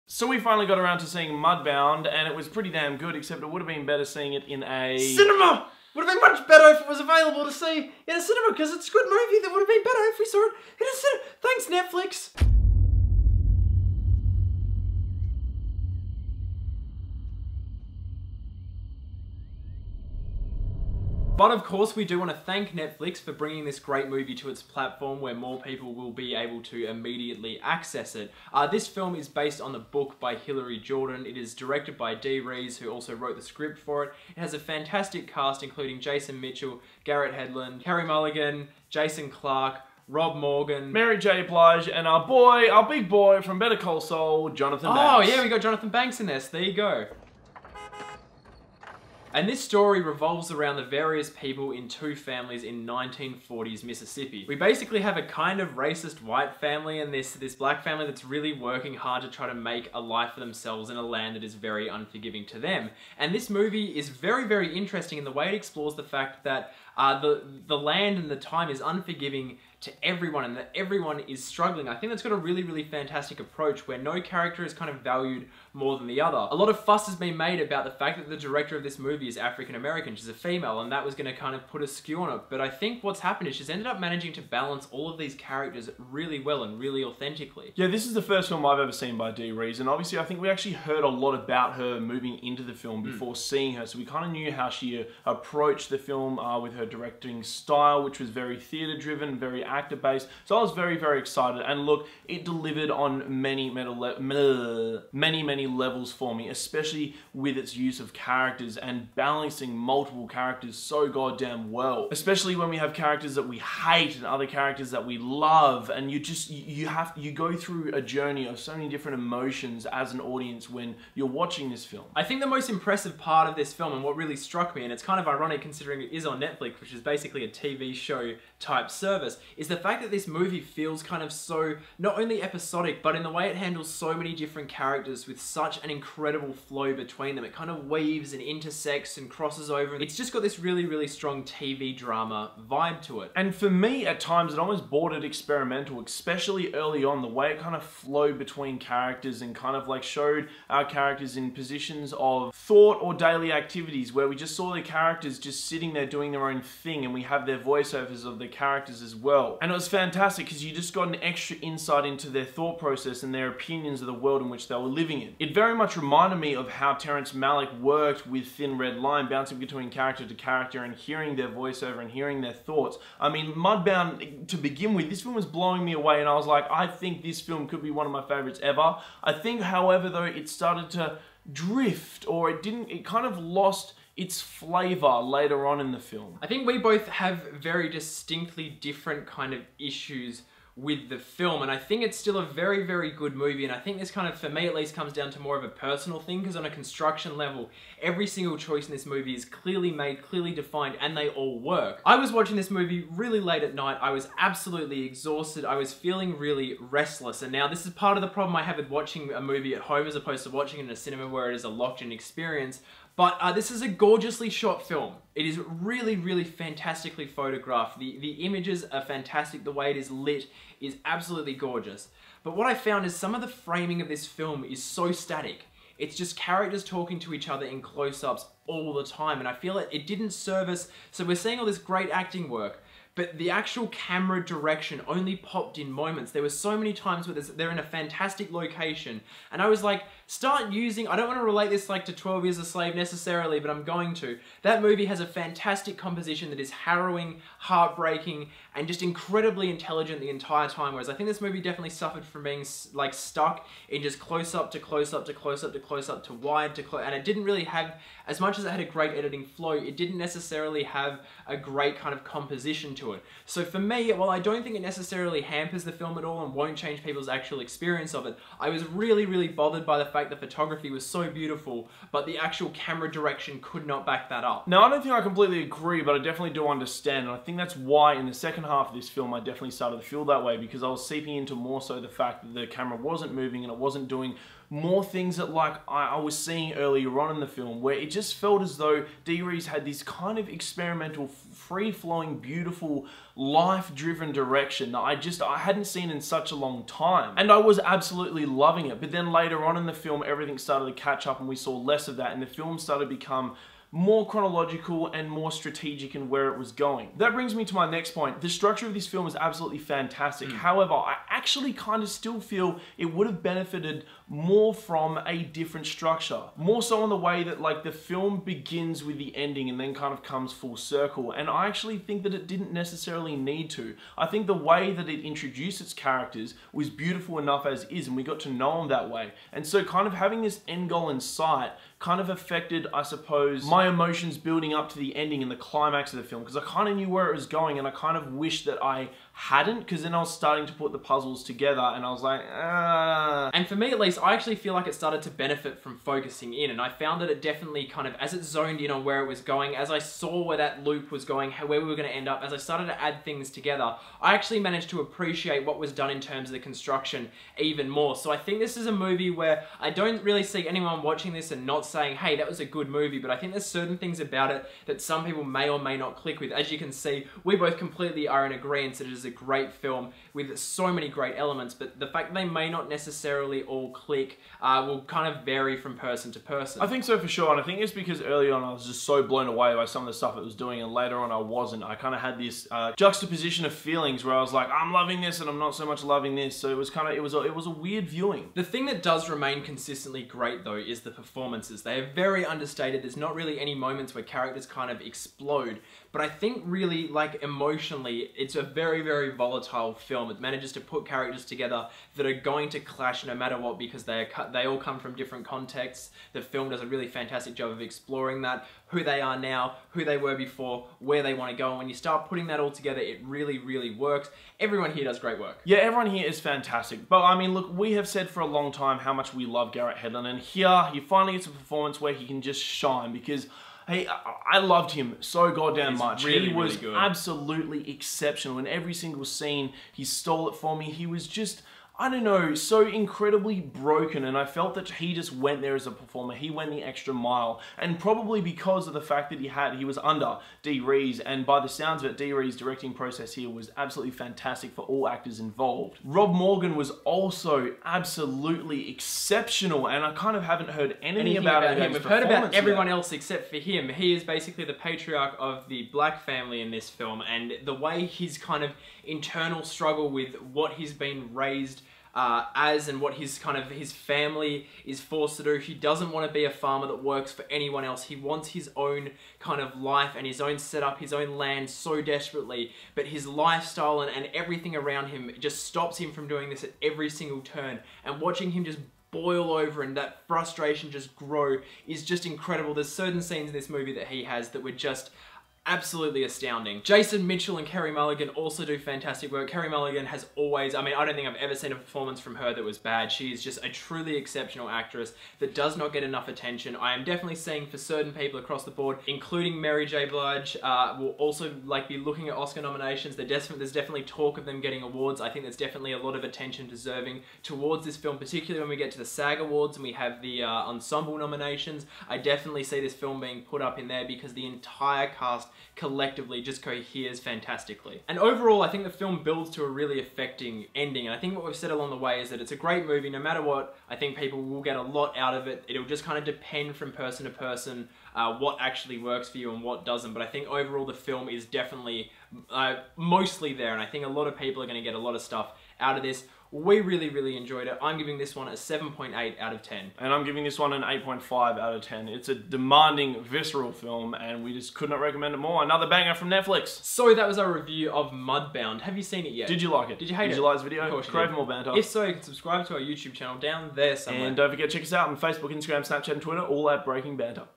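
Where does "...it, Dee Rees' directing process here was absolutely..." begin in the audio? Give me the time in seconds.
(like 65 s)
442 s.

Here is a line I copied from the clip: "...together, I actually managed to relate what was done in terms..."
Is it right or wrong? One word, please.
wrong.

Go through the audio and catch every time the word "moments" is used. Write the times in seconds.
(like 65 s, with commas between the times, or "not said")
235 s, 393 s.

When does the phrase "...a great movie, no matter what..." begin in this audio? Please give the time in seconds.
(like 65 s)
522 s.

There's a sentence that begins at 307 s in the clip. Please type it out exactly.
That brings me to my next point.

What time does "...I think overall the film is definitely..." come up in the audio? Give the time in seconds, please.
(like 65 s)
530 s.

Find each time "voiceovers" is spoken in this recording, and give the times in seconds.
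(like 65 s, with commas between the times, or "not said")
157 s, 171 s.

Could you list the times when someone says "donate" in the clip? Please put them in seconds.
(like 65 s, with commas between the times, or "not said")
not said.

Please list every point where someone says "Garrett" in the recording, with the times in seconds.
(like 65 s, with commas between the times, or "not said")
37 s, 419 s.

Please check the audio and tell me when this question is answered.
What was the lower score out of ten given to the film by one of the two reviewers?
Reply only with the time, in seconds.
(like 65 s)
538 s.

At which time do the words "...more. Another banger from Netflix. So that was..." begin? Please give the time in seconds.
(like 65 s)
545 s.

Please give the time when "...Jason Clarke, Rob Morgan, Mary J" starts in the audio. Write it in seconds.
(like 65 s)
38 s.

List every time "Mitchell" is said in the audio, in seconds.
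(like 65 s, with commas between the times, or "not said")
36 s, 487 s.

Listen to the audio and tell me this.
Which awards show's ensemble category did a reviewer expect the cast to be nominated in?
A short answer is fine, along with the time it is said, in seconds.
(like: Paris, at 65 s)
SAG Awards, at 509 s.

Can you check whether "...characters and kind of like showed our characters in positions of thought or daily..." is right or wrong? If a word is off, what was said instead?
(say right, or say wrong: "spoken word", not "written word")
right.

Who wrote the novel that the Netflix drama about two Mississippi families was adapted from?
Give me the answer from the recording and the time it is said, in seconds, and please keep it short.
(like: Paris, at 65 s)
Hilary Jordan, at 30 s.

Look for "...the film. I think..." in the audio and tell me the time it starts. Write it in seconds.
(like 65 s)
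185 s.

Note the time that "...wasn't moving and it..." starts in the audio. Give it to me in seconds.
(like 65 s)
282 s.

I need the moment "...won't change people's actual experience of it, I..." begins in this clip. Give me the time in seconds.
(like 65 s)
266 s.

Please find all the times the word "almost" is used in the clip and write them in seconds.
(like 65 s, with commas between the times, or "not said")
144 s.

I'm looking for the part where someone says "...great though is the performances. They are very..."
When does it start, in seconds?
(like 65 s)
390 s.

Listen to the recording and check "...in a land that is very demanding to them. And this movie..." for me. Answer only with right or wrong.
wrong.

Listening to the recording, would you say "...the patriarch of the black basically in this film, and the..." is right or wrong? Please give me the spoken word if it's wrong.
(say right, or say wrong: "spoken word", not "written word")
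wrong: "family", not "basically".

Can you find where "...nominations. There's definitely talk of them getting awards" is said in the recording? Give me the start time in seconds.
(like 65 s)
502 s.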